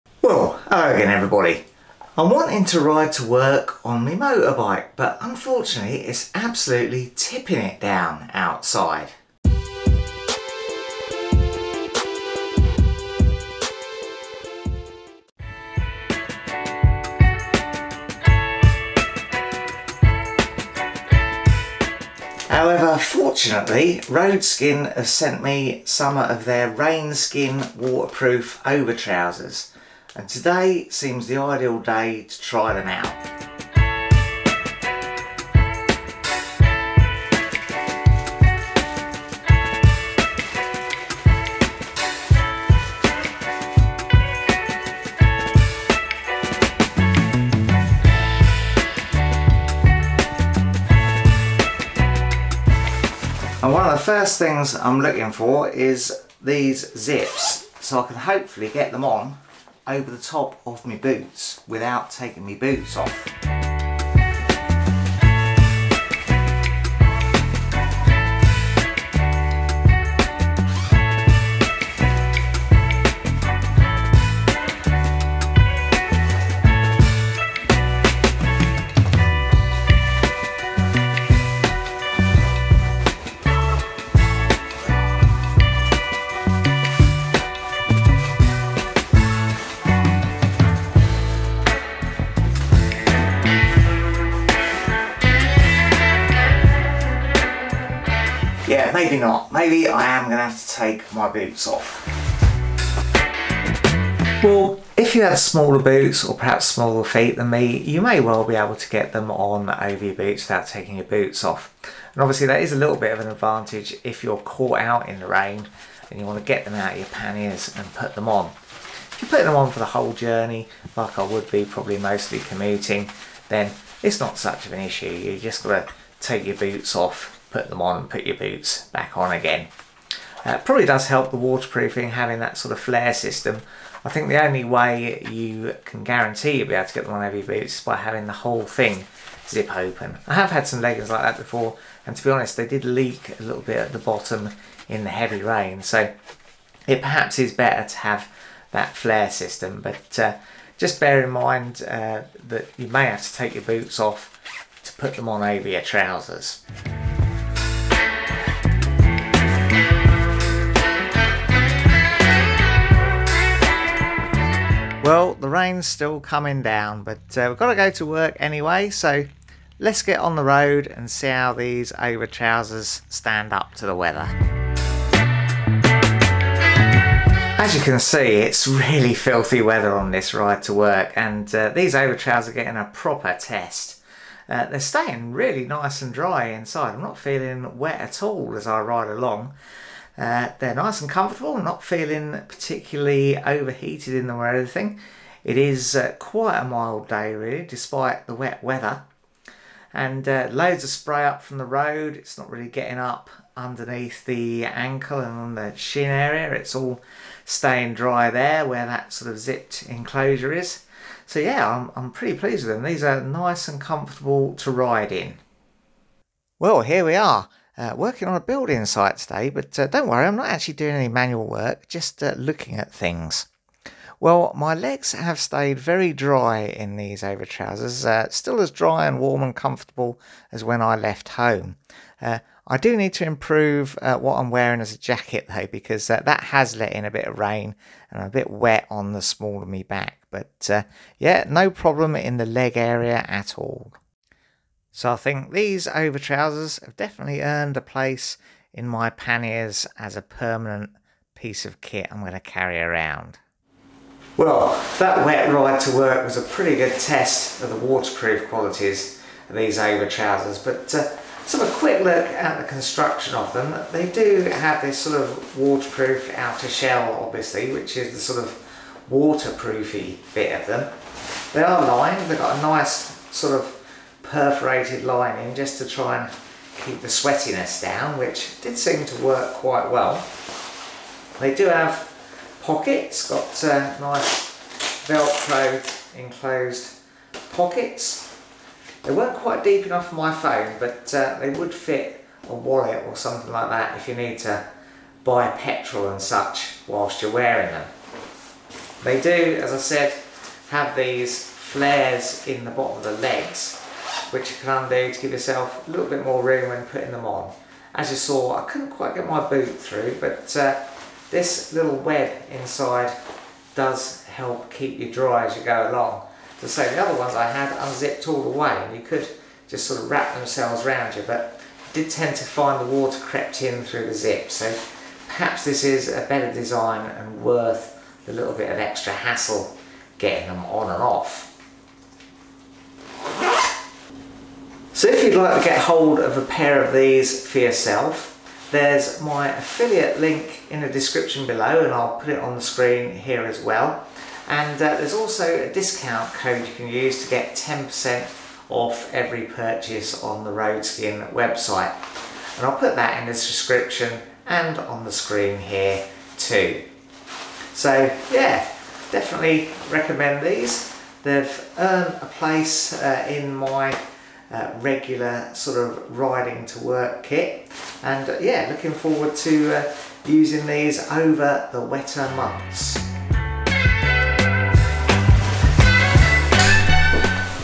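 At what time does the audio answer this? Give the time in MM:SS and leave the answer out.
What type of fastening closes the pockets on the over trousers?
04:45.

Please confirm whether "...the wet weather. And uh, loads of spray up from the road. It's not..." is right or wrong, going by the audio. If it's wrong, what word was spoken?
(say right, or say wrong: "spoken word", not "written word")
right.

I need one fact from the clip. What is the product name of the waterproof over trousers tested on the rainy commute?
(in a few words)
Rainskin.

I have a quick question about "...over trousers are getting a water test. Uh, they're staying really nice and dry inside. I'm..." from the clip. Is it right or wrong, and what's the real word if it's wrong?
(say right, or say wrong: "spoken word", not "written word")
wrong: "proper", not "water".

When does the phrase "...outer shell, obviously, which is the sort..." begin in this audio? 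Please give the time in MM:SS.
04:26.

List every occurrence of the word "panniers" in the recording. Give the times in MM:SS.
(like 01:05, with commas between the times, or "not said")
01:57, 04:09.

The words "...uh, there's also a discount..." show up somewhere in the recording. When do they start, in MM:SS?
05:44.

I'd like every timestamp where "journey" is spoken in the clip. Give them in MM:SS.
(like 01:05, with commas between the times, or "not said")
02:00.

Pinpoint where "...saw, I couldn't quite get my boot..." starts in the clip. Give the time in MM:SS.
05:08.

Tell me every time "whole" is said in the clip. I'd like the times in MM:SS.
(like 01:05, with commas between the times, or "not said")
01:59, 02:18.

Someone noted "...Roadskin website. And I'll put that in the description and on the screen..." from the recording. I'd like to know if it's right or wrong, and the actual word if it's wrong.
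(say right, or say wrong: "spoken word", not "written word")
right.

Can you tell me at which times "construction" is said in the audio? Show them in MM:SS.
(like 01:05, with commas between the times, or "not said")
04:22.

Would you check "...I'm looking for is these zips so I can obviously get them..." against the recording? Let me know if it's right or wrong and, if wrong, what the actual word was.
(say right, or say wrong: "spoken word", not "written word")
wrong: "hopefully", not "obviously".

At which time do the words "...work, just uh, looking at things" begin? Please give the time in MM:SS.
03:41.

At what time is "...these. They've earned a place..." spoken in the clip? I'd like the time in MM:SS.
06:00.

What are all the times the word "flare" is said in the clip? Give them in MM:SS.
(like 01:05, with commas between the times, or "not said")
02:12, 02:28, 05:01.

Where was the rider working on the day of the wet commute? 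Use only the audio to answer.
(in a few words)
a building site.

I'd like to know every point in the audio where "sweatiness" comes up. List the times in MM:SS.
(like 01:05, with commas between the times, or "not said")
04:37.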